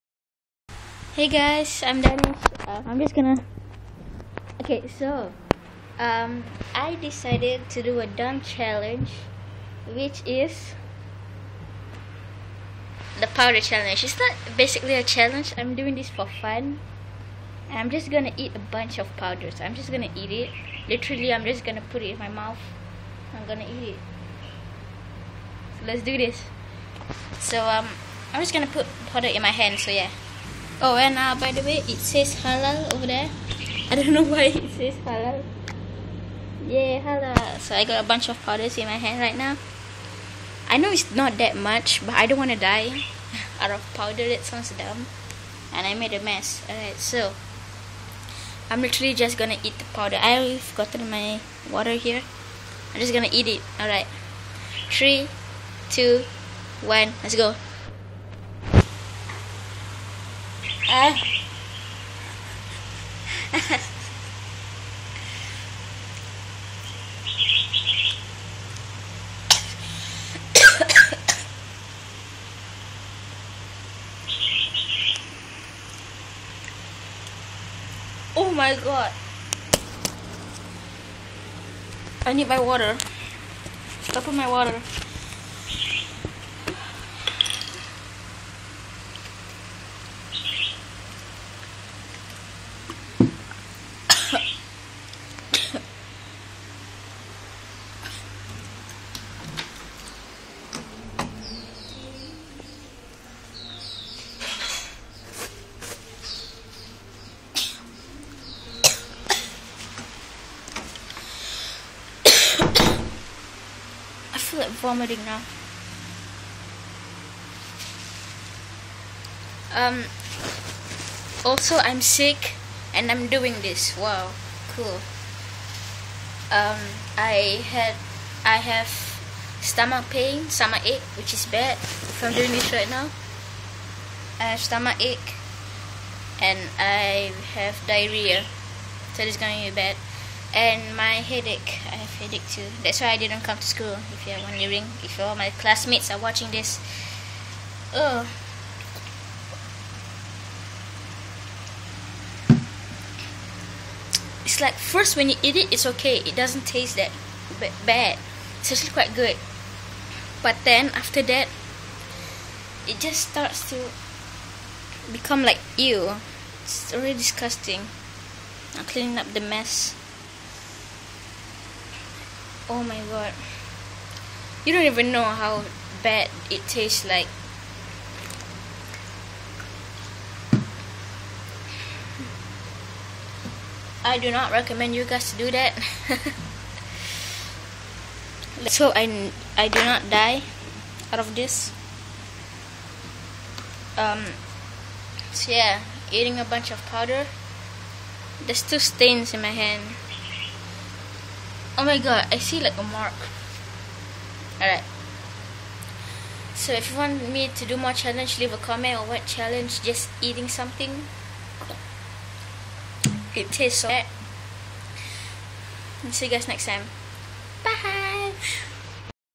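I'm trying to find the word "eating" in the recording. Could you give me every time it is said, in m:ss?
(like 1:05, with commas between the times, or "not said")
3:16, 3:30.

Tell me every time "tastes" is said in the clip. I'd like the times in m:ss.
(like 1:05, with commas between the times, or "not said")
2:36, 2:56, 3:33.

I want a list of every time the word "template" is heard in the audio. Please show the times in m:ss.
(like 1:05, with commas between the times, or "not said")
not said.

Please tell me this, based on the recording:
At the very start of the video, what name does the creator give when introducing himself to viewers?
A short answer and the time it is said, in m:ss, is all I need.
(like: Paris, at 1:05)
Danish, at 0:01.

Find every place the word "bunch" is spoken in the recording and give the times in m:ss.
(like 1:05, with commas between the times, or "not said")
0:18, 0:38, 3:16.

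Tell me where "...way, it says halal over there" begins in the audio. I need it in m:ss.
0:31.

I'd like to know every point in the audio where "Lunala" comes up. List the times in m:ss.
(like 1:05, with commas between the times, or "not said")
not said.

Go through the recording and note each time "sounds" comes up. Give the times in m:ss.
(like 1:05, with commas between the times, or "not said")
0:44.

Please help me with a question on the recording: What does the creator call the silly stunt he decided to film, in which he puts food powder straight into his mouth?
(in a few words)
the powder challenge.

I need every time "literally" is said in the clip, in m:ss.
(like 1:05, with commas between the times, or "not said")
0:20, 0:48.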